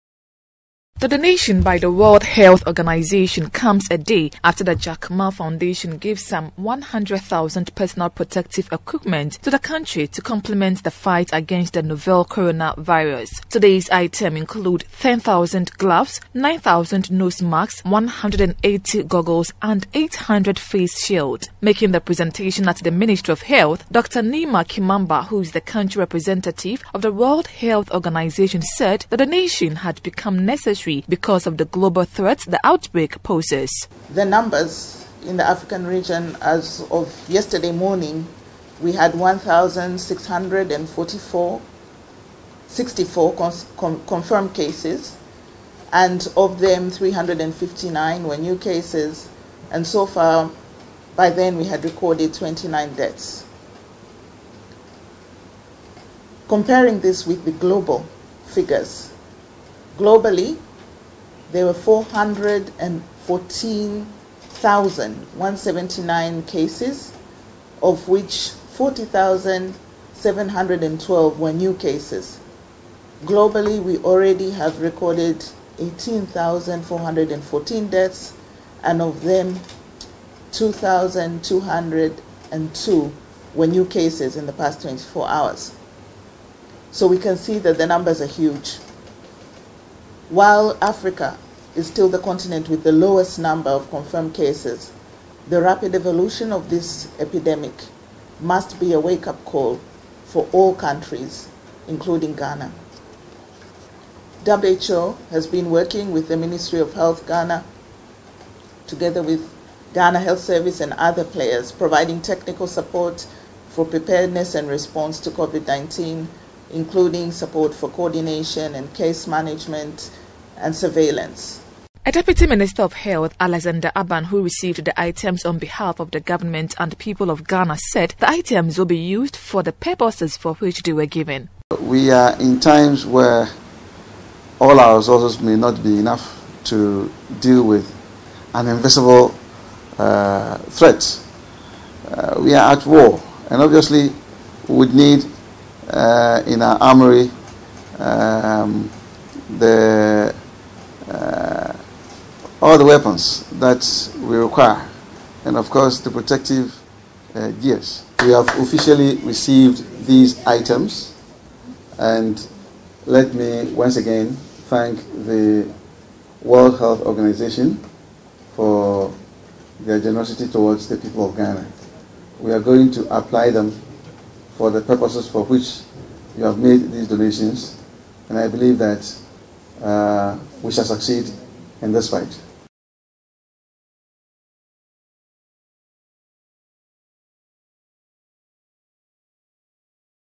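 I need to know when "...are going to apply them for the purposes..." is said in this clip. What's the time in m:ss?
2:52.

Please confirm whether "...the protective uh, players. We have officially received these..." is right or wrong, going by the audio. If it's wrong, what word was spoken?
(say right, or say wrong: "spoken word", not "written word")
wrong: "gears", not "players".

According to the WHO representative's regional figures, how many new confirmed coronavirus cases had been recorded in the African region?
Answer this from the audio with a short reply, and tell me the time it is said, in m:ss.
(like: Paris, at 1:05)
359, at 0:46.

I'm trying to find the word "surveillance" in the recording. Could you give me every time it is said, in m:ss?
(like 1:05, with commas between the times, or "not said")
2:00.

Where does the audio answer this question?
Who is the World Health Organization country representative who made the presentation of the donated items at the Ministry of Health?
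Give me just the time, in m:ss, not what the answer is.
0:23.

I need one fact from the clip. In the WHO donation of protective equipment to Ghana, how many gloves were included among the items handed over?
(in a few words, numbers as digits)
10,000.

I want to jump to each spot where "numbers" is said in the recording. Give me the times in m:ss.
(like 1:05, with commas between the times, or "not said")
0:34, 1:33.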